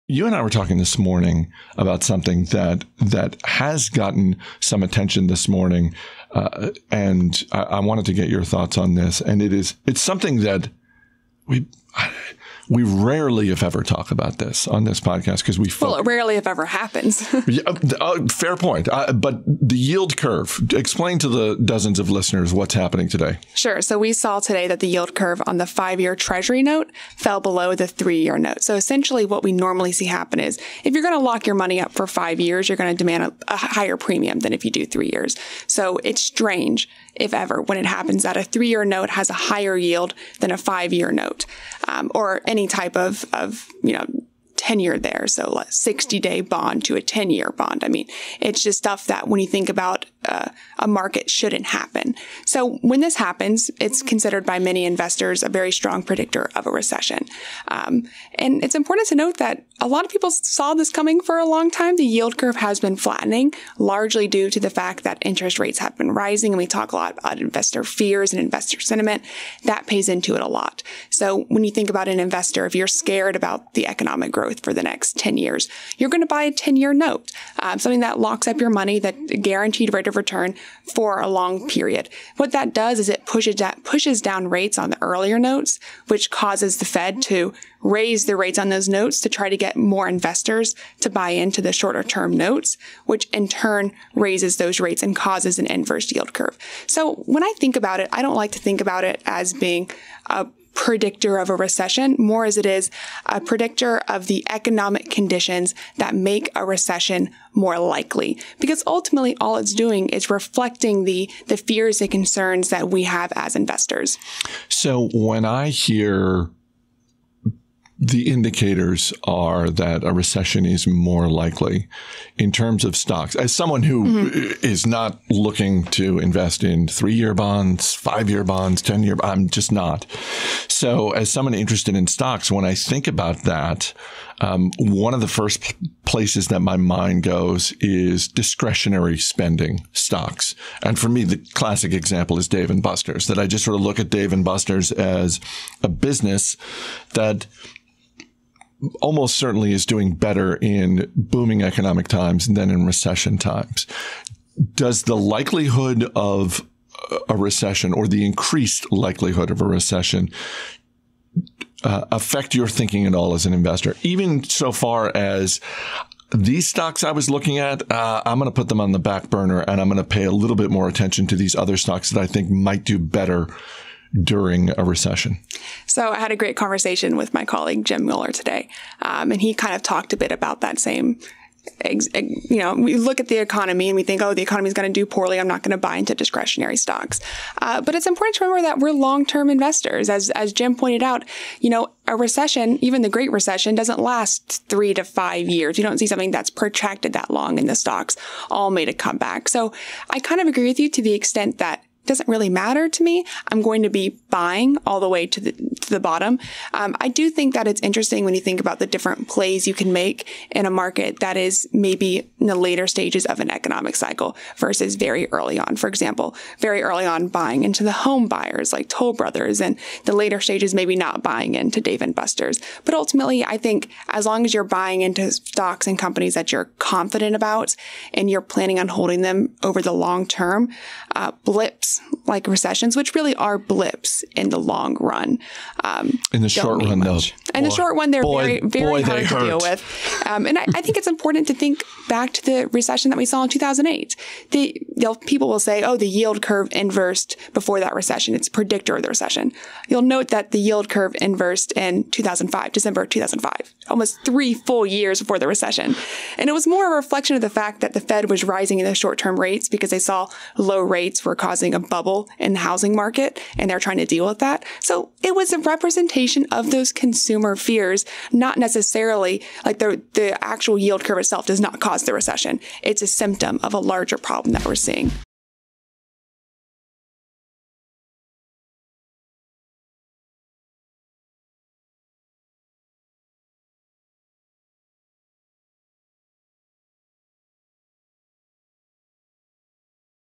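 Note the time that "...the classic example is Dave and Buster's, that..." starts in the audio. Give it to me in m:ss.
2:21.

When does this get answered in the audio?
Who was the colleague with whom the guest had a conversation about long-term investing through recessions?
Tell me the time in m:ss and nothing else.
2:57.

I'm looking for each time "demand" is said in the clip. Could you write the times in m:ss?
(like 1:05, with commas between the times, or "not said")
0:32.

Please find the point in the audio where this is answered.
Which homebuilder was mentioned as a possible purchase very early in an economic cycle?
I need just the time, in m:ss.
3:38.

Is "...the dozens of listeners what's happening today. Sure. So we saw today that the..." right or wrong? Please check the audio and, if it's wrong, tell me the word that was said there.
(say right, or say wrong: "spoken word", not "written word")
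right.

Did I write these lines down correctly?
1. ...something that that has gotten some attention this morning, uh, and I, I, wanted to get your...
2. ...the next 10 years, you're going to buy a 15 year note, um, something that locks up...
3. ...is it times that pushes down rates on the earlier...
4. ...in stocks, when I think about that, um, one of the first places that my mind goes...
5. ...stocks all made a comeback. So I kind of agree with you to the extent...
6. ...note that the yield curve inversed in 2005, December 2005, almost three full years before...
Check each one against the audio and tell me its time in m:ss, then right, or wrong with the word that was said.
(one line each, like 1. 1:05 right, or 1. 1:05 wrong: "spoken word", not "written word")
1. 0:02 right
2. 1:14 wrong: "10", not "15"
3. 1:22 wrong: "pushes", not "times"
4. 2:11 right
5. 3:17 right
6. 4:10 right.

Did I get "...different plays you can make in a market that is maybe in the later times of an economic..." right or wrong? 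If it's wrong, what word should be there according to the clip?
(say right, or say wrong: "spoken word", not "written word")
wrong: "stages", not "times".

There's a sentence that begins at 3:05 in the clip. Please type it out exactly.
I'm not going to buy into discretionary stocks.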